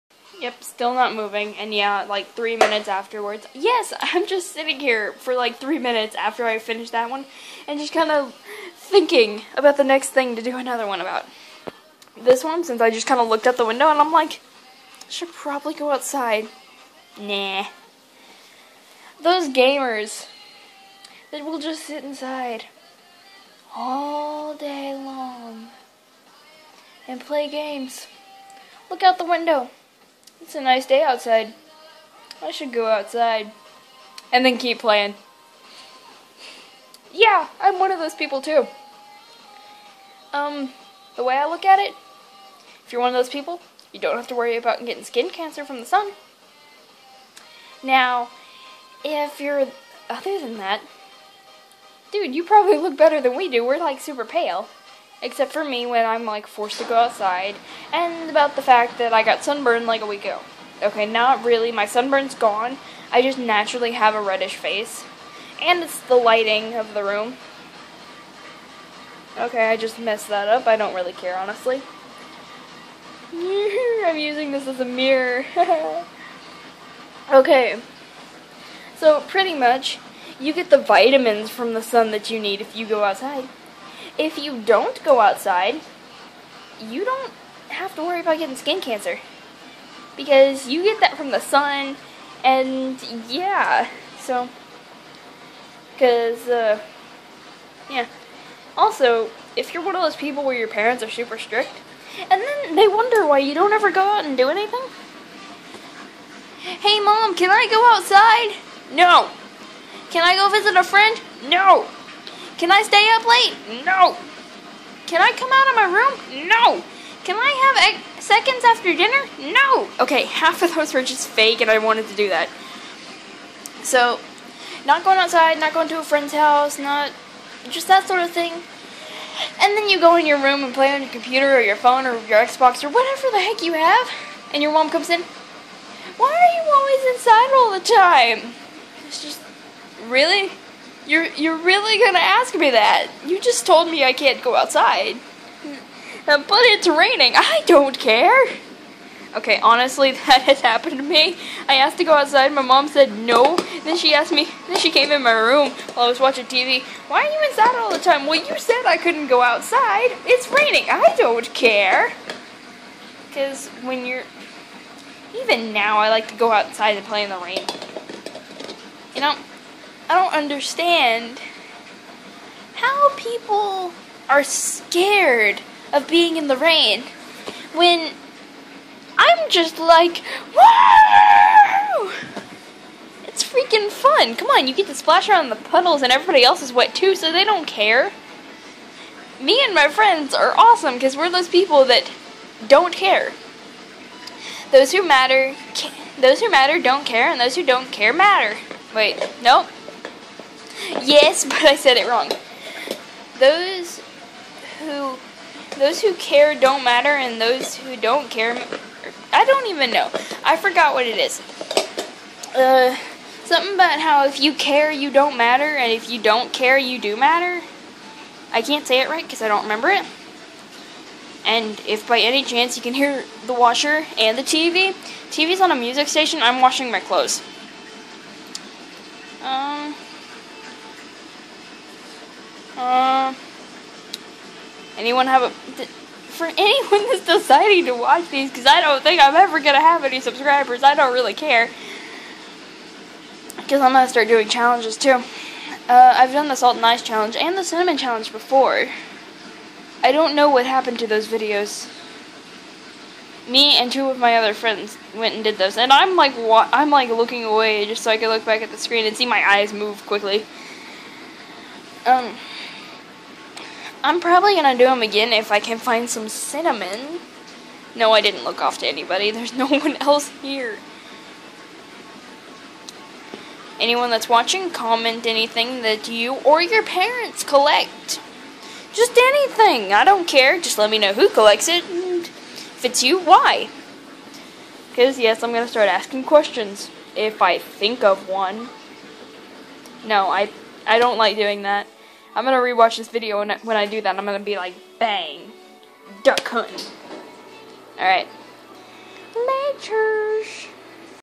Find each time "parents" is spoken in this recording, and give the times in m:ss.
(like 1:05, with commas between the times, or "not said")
1:40, 4:36.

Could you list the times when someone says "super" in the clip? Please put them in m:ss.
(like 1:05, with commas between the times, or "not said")
0:53, 1:41.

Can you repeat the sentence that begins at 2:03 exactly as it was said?
So, not going outside, not going to a friend's house, not just that sort of thing.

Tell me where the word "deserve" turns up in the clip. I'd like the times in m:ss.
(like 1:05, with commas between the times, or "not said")
not said.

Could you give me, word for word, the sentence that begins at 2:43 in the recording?
Because when you're even now, I like to go outside and play in the rain.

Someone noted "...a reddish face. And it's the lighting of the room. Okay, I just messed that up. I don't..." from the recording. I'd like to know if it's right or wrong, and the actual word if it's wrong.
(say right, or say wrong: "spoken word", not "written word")
right.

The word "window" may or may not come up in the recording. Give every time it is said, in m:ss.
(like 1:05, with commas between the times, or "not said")
0:13, 0:29.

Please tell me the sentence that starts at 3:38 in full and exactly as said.
I can't say it right because I don't remember it.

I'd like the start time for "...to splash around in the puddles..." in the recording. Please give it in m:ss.
3:04.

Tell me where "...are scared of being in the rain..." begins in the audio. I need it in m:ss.
2:54.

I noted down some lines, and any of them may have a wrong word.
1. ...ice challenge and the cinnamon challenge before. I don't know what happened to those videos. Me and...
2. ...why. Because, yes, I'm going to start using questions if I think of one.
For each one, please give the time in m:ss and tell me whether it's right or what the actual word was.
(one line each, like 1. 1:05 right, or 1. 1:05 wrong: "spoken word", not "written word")
1. 4:06 right
2. 4:43 wrong: "asking", not "using".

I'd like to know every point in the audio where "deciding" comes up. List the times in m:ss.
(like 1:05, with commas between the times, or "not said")
3:57.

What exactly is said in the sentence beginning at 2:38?
Well, you said I couldn't go outside.